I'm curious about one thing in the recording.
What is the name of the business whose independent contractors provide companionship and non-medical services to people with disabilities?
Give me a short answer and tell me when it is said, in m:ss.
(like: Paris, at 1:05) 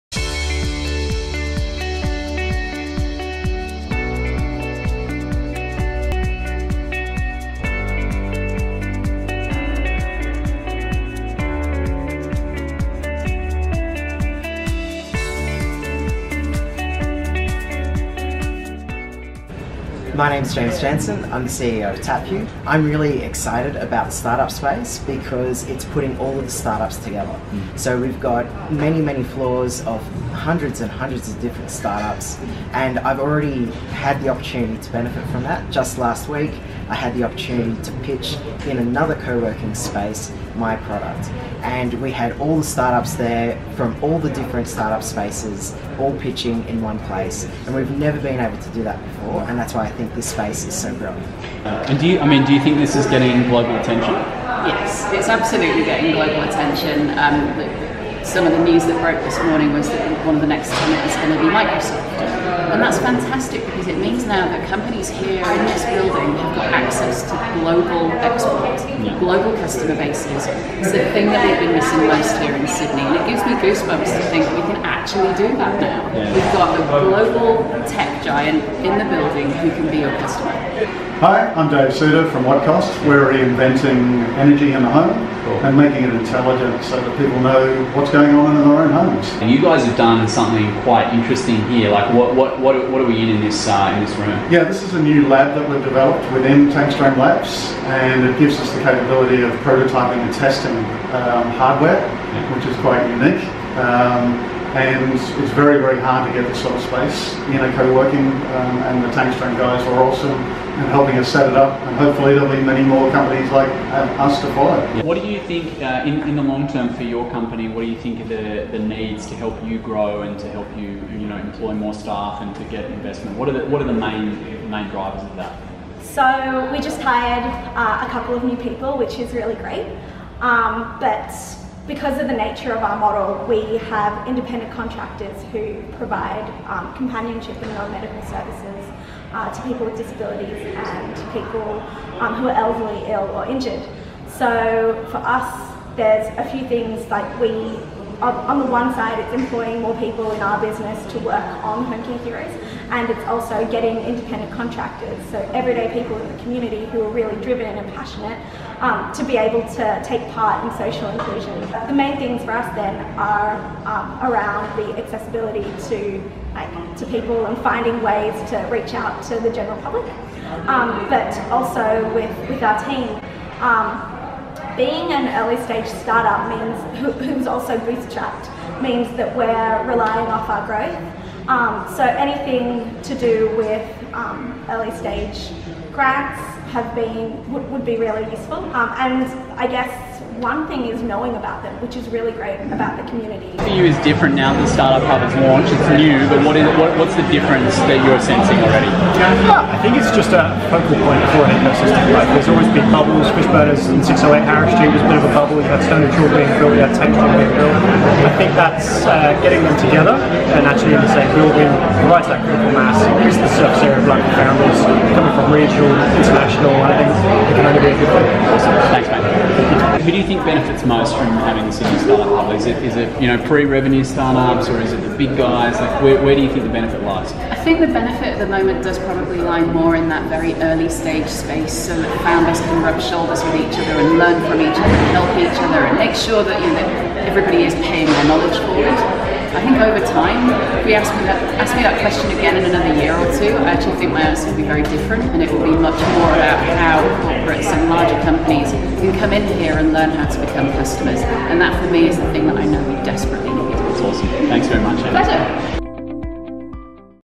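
Home Care Heroes, at 2:31.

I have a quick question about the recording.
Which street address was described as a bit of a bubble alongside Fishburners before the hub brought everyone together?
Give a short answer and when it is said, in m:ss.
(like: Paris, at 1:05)
608 Harris Street, at 3:24.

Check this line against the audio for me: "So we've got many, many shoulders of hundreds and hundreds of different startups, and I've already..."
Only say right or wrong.
wrong.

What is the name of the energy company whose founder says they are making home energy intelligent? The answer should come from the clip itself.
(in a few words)
Wattcost.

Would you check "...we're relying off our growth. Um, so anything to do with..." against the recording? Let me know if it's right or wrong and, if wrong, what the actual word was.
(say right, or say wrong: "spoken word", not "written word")
right.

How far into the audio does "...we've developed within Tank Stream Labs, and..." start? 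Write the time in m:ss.
1:35.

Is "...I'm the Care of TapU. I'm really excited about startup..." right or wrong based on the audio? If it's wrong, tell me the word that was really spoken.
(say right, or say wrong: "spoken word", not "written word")
wrong: "CEO", not "Care".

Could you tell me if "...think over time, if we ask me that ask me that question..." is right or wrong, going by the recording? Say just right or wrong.
right.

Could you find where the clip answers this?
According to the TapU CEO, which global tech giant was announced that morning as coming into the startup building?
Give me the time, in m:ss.
1:01.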